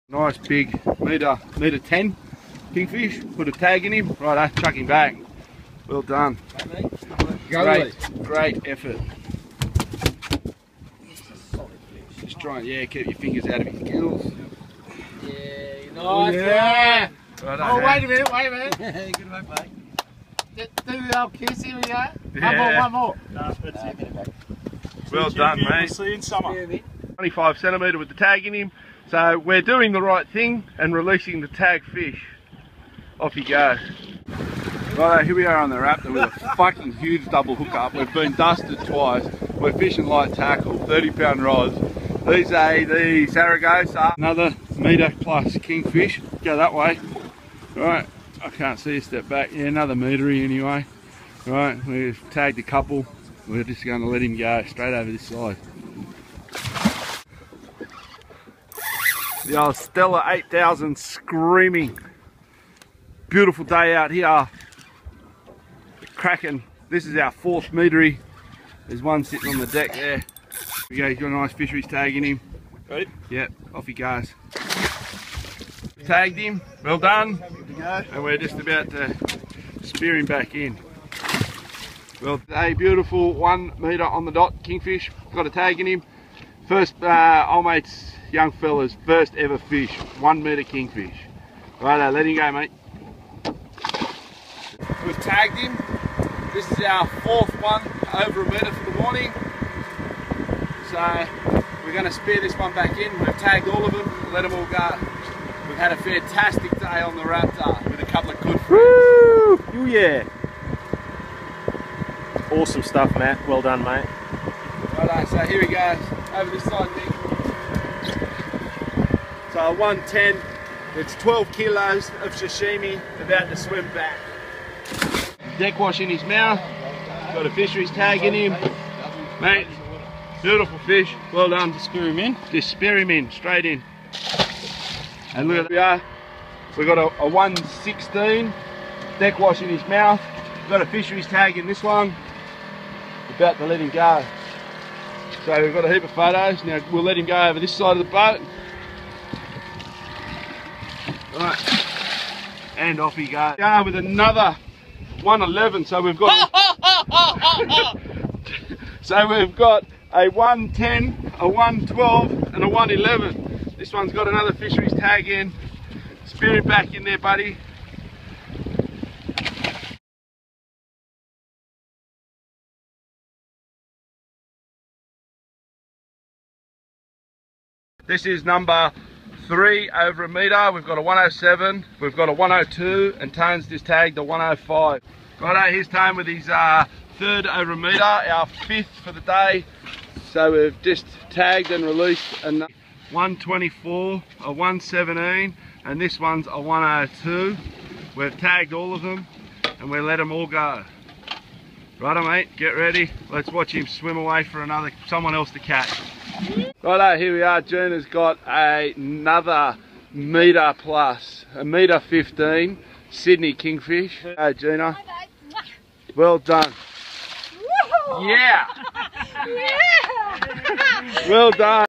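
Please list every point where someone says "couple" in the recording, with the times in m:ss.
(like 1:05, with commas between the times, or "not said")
0:52, 1:48.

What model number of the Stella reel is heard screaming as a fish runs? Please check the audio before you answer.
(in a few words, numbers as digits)
8000.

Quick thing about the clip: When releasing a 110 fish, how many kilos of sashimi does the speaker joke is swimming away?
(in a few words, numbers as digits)
12.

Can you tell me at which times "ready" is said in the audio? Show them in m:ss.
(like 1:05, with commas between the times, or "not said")
1:12, 3:22.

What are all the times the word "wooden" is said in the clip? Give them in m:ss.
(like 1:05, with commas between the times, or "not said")
not said.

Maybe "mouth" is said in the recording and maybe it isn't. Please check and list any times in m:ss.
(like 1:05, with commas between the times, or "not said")
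2:06, 2:19.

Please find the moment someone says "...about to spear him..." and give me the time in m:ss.
1:18.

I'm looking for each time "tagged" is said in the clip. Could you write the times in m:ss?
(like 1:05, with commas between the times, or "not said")
0:52, 1:16, 1:35, 1:43, 3:03, 3:11, 3:18.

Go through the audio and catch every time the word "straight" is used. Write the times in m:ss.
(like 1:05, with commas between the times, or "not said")
0:54, 2:13.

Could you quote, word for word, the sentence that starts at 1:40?
So we're going to spear this one back in.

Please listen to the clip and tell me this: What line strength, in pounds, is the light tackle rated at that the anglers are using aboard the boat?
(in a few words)
30 pound.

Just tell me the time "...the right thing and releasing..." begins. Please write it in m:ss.
0:29.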